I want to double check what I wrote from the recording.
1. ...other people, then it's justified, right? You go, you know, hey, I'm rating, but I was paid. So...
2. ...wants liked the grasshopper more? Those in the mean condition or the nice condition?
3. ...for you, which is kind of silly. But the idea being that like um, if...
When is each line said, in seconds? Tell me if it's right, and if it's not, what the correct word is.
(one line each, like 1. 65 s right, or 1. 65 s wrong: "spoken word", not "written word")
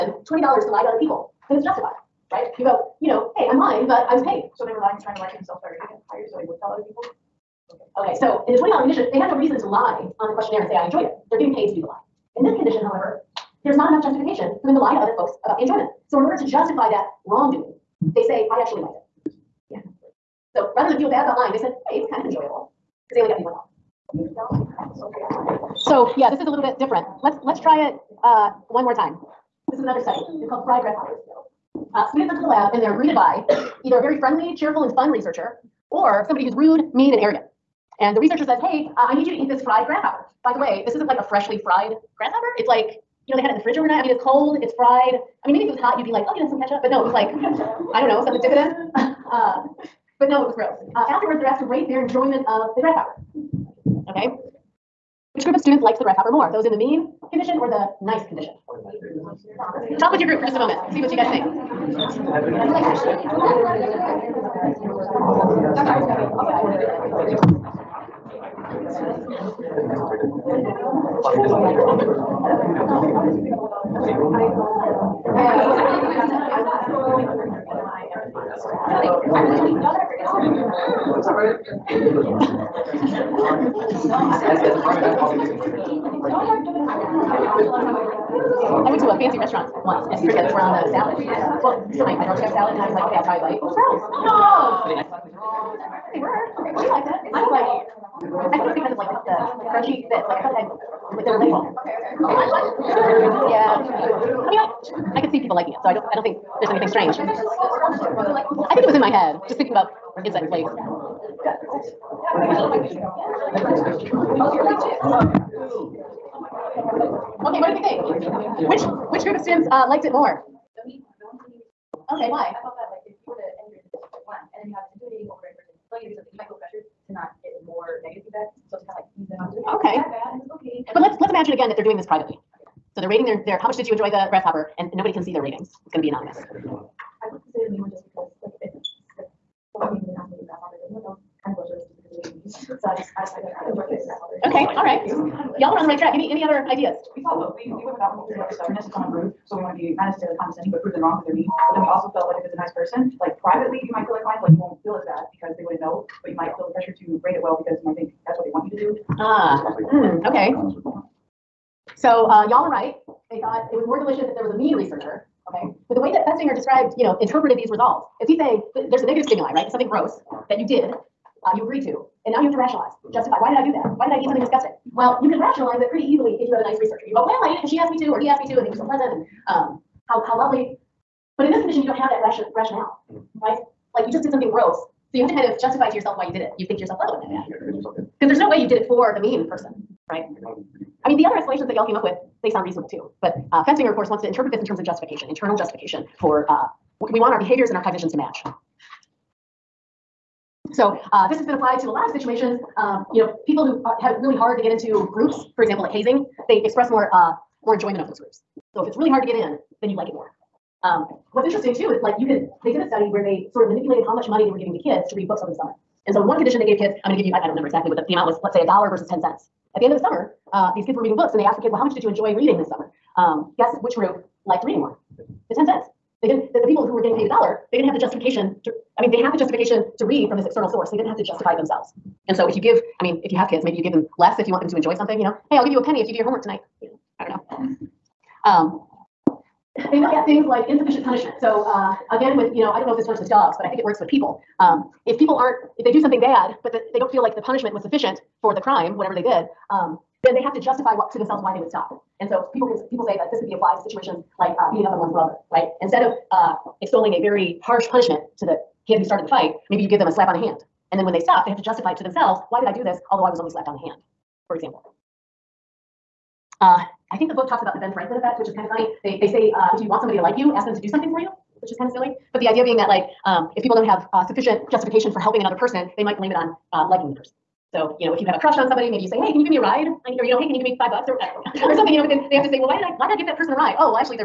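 1. 0 s wrong: "lying", not "rating"
2. 55 s wrong: "students", not "wants"
3. 271 s right.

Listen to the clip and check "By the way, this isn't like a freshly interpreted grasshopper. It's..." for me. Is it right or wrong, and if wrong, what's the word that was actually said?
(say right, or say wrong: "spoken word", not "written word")
wrong: "fried", not "interpreted".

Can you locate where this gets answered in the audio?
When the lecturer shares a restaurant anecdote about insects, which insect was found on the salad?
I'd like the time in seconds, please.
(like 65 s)
90 s.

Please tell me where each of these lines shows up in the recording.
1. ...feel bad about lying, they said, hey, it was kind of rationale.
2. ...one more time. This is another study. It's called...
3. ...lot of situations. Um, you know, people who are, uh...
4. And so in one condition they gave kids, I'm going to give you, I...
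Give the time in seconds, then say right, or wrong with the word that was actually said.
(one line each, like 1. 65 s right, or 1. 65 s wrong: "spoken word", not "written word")
1. 20 s wrong: "enjoyable", not "rationale"
2. 28 s right
3. 201 s right
4. 216 s right.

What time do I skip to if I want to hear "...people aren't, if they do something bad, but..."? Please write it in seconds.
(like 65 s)
245 s.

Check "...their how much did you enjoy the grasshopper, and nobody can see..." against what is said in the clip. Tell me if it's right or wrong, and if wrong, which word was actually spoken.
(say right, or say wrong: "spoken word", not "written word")
right.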